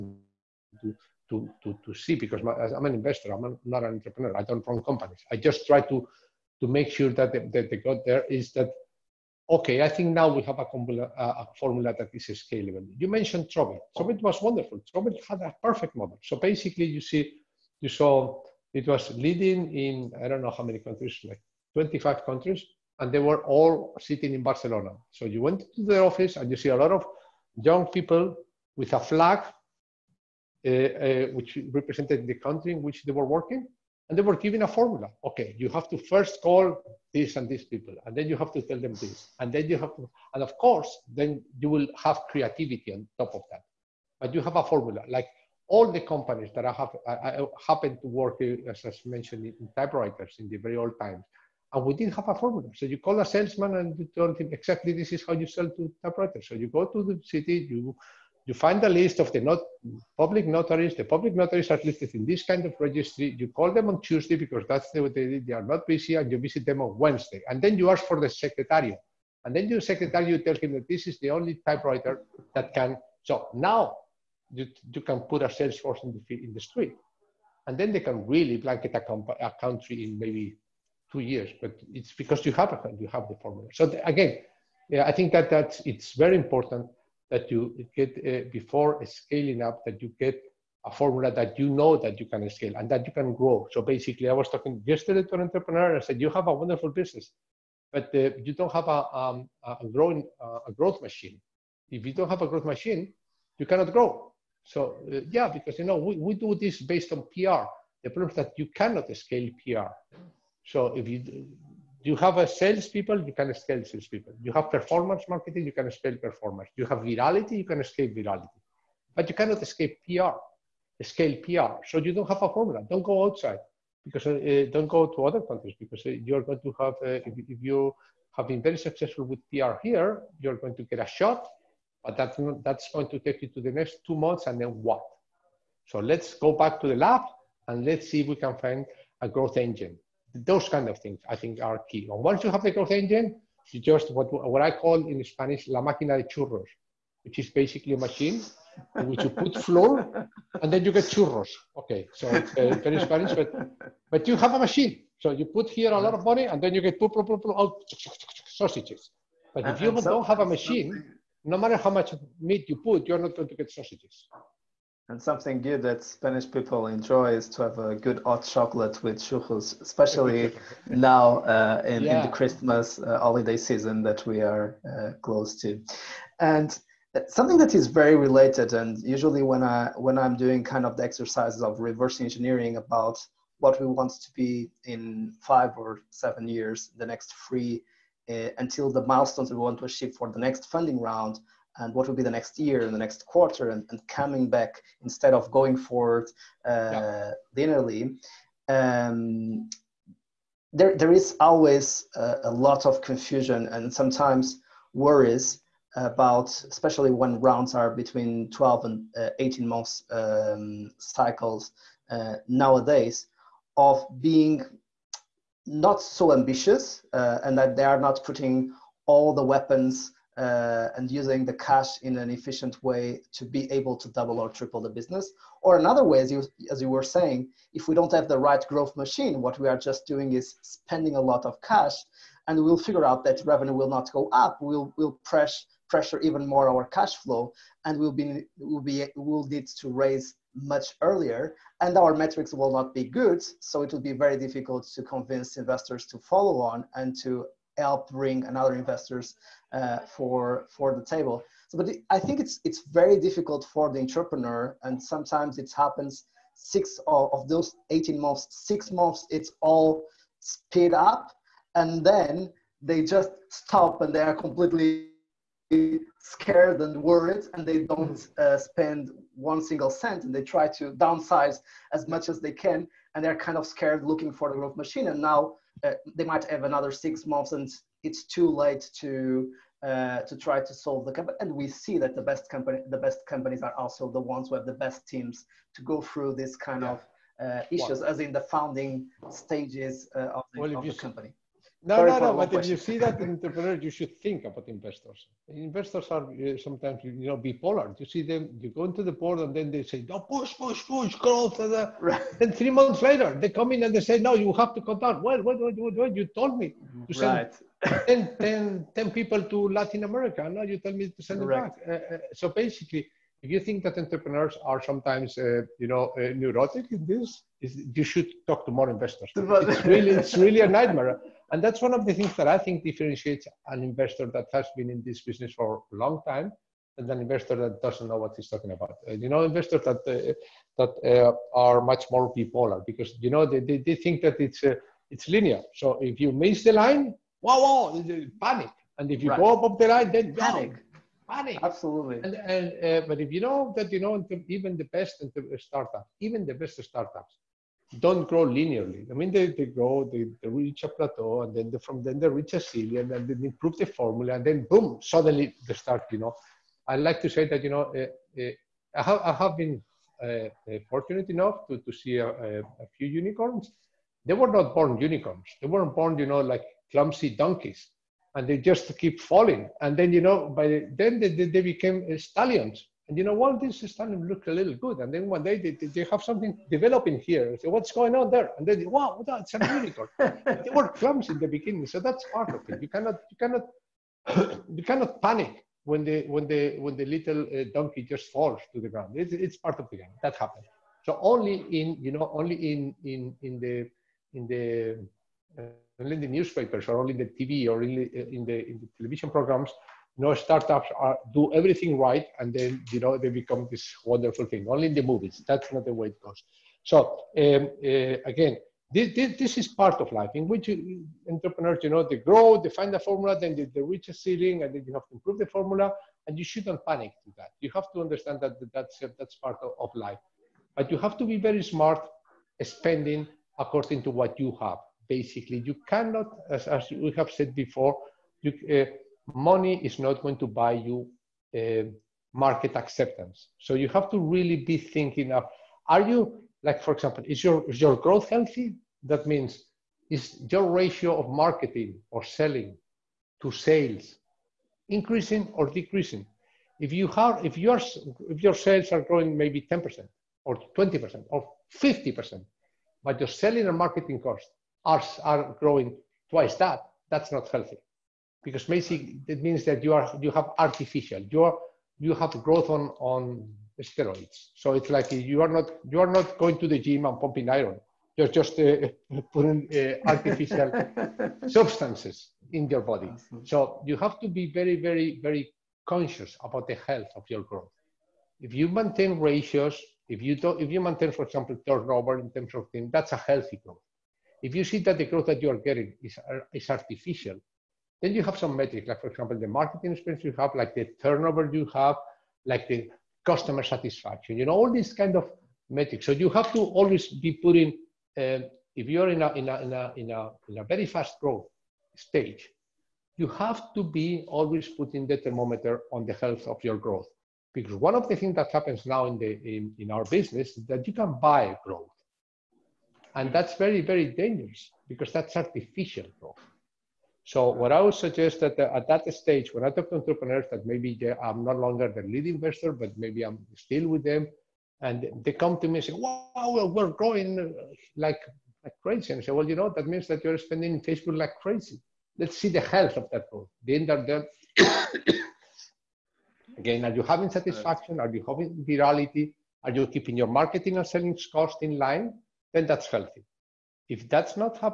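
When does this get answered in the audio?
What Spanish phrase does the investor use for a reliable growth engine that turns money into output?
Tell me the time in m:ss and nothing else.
2:25.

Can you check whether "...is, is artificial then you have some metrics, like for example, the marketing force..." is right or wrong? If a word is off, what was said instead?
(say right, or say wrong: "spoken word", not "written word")
wrong: "experience", not "force".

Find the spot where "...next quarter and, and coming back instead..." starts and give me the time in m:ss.
3:12.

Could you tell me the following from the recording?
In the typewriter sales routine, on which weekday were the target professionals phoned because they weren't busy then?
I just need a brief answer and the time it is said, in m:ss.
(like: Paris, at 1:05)
Tuesday, at 1:04.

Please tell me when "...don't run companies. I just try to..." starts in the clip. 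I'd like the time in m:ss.
0:04.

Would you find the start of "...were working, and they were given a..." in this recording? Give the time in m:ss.
0:33.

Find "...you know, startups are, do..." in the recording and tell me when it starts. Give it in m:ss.
6:40.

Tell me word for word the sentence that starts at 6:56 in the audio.
And you shouldn't panic to that.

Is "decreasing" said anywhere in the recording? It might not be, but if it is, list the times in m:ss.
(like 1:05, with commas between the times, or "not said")
7:25.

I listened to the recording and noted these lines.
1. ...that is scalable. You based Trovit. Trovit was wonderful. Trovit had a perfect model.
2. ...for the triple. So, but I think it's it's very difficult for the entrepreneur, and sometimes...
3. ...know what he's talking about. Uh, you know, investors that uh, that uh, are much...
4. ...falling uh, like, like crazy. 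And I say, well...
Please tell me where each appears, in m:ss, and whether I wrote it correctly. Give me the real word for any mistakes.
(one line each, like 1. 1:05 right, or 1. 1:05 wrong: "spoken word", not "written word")
1. 0:11 wrong: "mentioned", not "based"
2. 4:10 wrong: "table", not "triple"
3. 5:28 right
4. 8:46 wrong: "growing", not "falling".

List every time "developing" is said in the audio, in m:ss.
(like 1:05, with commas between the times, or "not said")
6:16.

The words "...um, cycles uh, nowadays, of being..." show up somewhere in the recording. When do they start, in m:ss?
3:30.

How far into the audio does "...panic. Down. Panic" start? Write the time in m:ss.
5:40.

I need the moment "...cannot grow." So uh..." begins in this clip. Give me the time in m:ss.
1:43.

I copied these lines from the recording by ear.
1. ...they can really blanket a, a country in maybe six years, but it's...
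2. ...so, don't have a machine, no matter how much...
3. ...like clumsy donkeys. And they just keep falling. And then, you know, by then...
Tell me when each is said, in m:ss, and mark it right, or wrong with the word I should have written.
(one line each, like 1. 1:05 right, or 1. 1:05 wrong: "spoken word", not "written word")
1. 1:17 wrong: "two", not "six"
2. 2:39 right
3. 6:06 right.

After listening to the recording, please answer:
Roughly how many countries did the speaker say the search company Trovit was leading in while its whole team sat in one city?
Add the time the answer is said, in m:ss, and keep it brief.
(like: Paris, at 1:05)
25, at 0:21.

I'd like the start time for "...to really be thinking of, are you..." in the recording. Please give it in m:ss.
7:14.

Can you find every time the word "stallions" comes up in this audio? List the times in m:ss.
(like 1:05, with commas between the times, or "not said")
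6:12.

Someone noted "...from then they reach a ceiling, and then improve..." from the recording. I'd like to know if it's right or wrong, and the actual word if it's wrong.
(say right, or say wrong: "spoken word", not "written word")
right.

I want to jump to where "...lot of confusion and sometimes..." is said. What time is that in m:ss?
3:22.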